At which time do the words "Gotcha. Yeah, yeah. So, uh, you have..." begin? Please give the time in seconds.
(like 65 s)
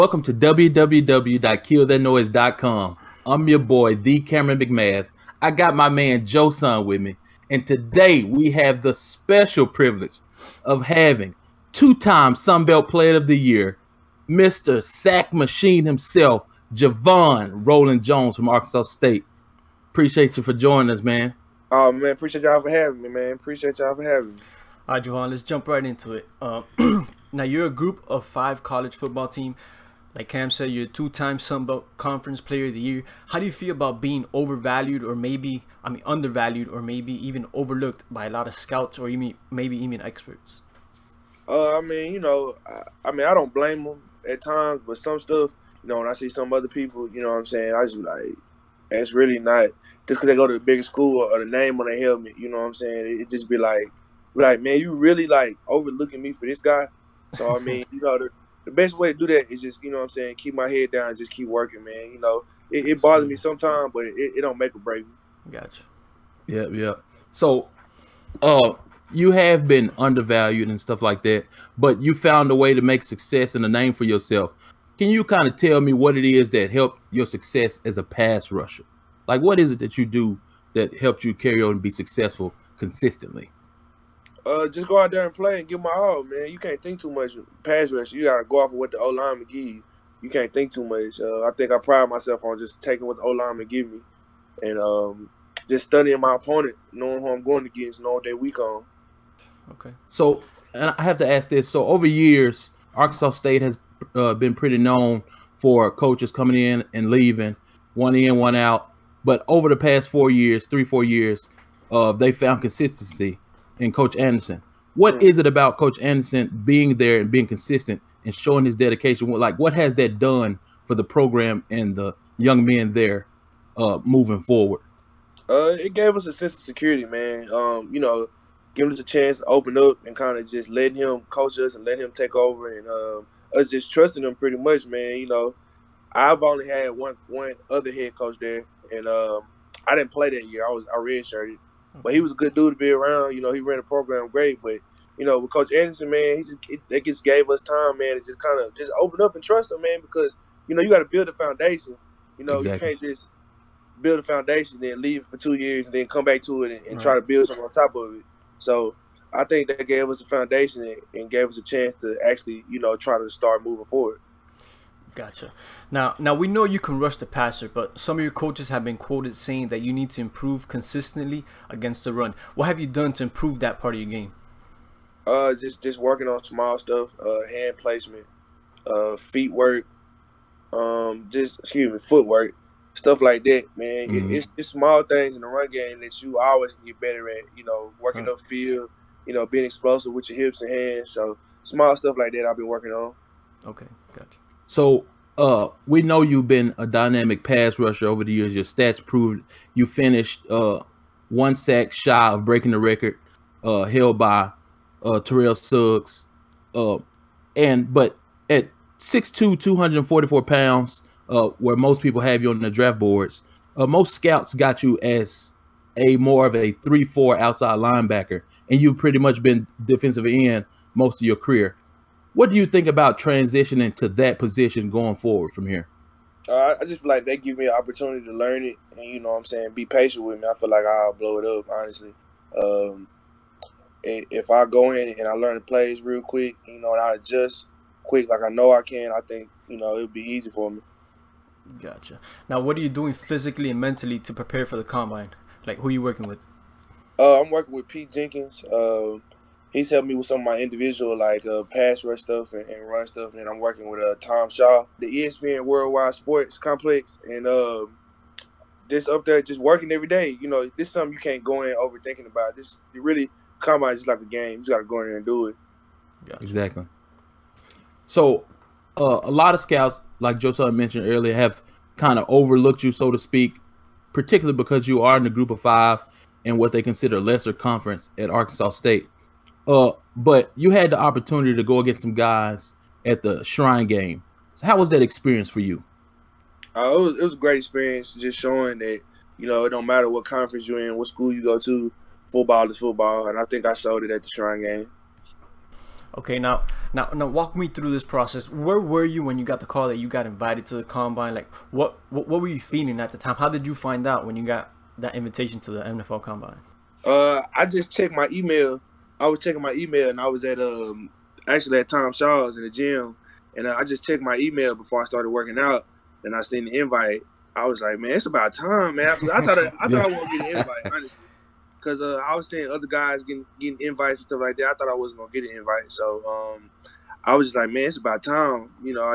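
65 s.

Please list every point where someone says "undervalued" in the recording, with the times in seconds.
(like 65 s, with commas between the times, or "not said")
36 s, 69 s.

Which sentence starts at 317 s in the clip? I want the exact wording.
I was like, man, it's about time, man.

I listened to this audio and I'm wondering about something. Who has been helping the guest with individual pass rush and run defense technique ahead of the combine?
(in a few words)
Pete Jenkins.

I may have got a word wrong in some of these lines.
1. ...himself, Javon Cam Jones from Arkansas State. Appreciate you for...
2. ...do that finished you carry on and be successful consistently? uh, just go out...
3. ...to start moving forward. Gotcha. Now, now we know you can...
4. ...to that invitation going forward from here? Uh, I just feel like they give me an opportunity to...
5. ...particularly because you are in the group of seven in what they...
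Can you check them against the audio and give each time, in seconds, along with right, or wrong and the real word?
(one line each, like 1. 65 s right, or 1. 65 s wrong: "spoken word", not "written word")
1. 15 s wrong: "Roland", not "Cam"
2. 80 s wrong: "helped", not "finished"
3. 163 s right
4. 223 s wrong: "position", not "invitation"
5. 274 s wrong: "five", not "seven".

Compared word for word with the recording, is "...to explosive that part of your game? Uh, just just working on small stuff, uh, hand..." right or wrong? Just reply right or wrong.
wrong.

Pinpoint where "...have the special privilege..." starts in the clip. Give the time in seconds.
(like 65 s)
8 s.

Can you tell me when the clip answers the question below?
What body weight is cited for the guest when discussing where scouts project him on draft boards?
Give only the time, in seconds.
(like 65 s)
209 s.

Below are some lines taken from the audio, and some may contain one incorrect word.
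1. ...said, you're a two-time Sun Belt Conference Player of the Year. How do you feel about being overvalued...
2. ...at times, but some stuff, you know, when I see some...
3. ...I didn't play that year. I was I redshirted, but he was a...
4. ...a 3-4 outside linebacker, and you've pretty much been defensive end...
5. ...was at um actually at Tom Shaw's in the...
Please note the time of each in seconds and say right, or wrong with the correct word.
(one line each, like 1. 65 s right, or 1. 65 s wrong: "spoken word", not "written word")
1. 30 s right
2. 44 s right
3. 139 s right
4. 216 s right
5. 310 s right.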